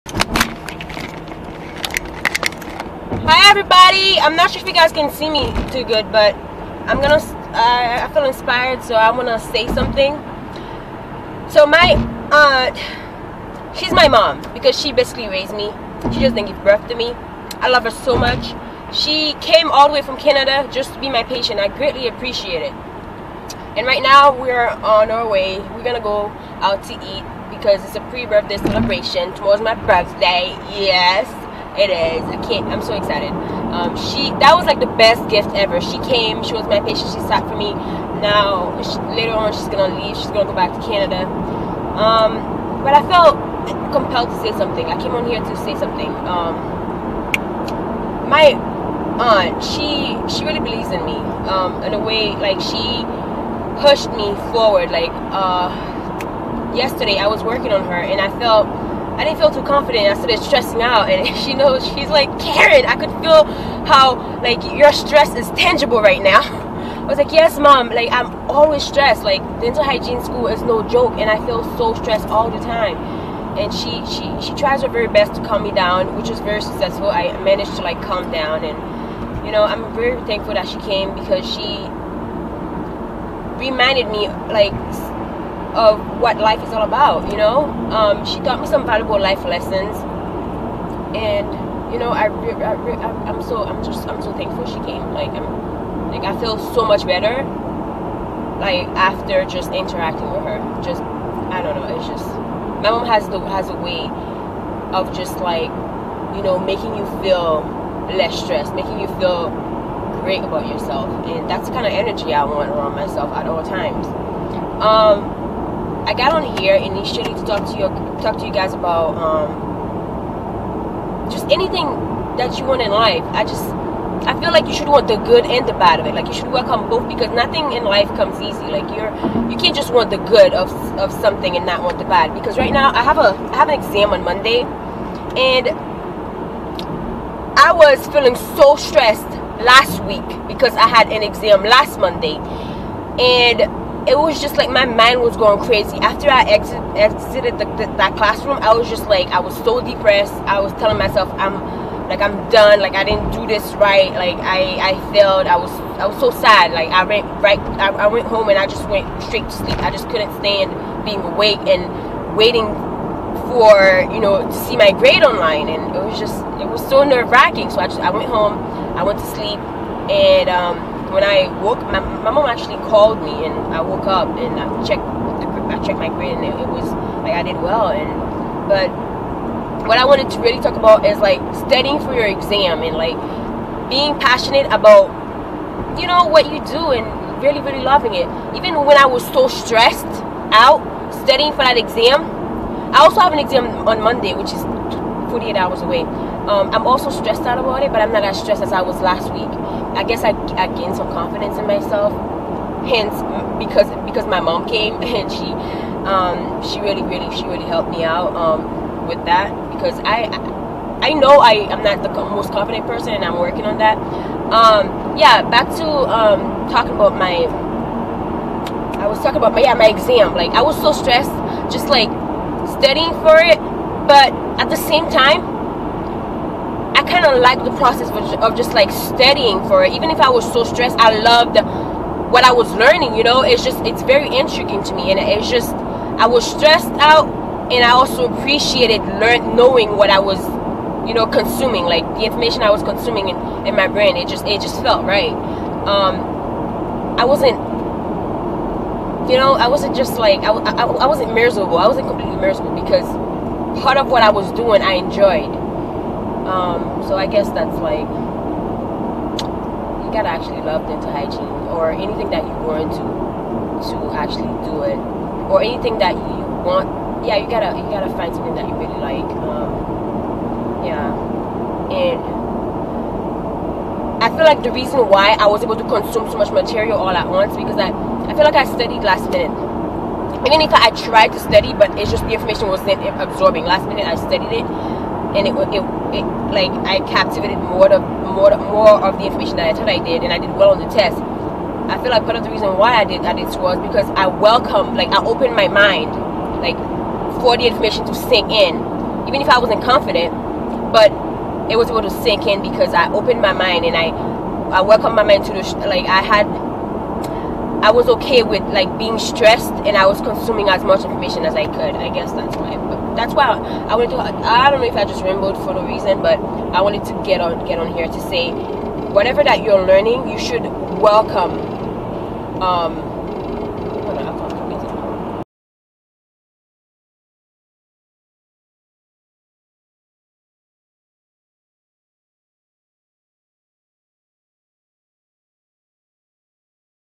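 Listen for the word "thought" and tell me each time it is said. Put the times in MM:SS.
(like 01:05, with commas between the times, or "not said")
04:49.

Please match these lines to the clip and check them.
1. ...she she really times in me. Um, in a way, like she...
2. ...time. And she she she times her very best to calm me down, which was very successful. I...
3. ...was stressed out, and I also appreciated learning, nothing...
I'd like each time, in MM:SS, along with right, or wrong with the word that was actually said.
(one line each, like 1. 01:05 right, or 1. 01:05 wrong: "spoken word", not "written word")
1. 00:49 wrong: "believes", not "times"
2. 01:12 wrong: "tries", not "times"
3. 03:56 wrong: "knowing", not "nothing".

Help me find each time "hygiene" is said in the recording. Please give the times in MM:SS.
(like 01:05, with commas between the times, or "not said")
01:09, 04:21.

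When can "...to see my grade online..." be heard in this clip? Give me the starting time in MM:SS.
02:44.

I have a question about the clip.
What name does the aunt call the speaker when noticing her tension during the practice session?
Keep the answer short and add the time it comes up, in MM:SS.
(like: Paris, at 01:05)
Karen, at 01:02.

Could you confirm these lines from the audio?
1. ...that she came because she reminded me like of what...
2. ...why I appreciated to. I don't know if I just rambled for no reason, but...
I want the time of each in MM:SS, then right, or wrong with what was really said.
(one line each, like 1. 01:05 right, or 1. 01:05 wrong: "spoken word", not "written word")
1. 01:20 right
2. 05:13 wrong: "wanted", not "appreciated".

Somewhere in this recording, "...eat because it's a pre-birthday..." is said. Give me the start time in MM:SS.
00:26.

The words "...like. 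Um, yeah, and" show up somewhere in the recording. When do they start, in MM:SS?
04:28.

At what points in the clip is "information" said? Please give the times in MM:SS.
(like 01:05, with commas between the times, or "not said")
04:02, 04:42, 04:49, 04:57, 05:11.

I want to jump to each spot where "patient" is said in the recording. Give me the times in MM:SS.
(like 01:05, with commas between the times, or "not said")
00:21, 00:36.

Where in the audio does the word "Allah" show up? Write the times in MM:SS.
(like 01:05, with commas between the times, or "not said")
not said.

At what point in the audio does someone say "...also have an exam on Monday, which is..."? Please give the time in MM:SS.
03:12.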